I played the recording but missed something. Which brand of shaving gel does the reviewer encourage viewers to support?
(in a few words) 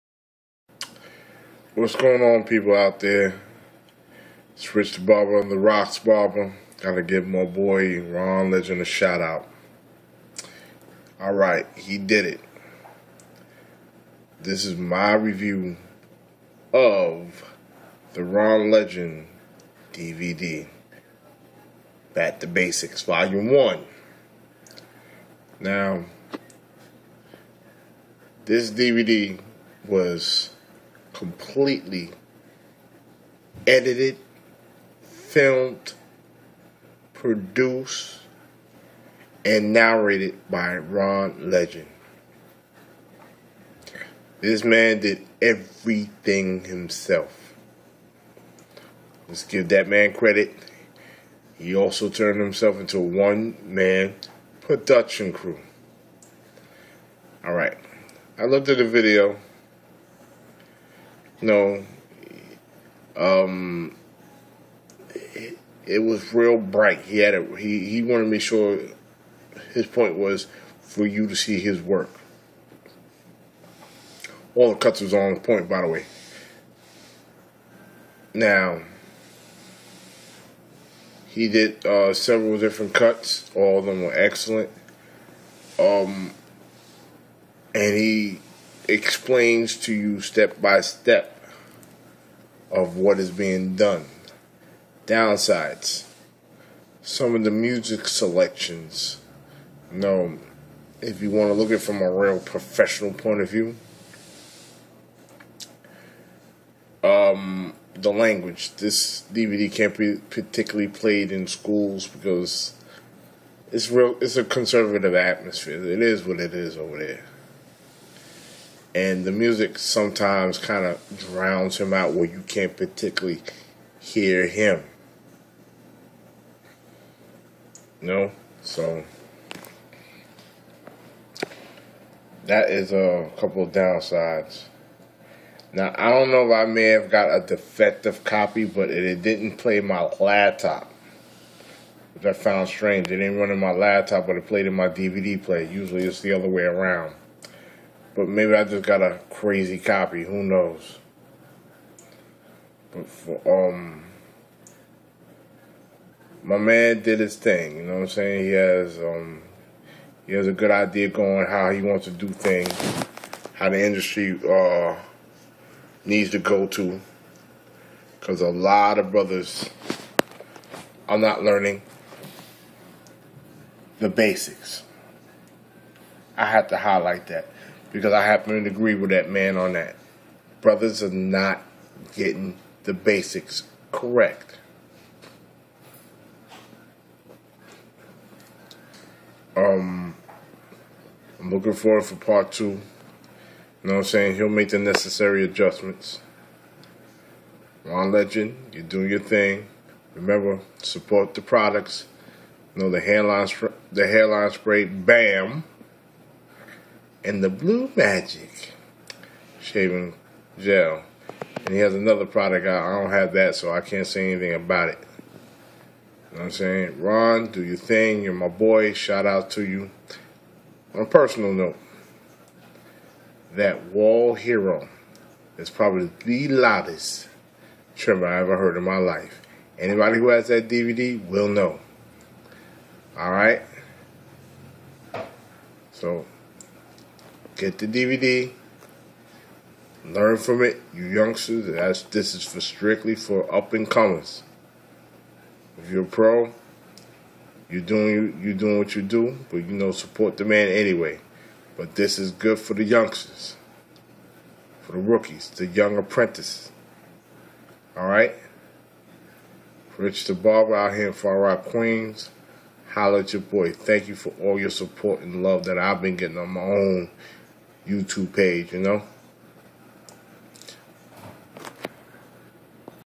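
Blue Magic.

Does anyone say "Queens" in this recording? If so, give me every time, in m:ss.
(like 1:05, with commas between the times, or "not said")
4:21.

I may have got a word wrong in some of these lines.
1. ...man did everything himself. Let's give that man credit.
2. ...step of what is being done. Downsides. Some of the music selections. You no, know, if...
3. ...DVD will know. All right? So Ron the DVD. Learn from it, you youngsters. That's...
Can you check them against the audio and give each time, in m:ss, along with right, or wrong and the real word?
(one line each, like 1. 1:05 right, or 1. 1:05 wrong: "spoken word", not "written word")
1. 0:44 right
2. 1:30 right
3. 3:50 wrong: "Get", not "Ron".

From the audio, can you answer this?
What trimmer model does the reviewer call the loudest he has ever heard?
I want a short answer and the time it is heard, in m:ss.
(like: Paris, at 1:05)
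Wahl Hero, at 3:43.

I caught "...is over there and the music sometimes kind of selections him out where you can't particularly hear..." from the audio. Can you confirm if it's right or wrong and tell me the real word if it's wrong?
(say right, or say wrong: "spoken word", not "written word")
wrong: "drowns", not "selections".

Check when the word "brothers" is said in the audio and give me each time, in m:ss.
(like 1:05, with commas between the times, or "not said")
2:49, 3:00.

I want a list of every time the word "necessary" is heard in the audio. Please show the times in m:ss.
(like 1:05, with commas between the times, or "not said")
3:14.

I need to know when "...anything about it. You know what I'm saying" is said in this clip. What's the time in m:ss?
3:34.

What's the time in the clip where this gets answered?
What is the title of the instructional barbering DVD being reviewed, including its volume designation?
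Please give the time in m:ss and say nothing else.
0:22.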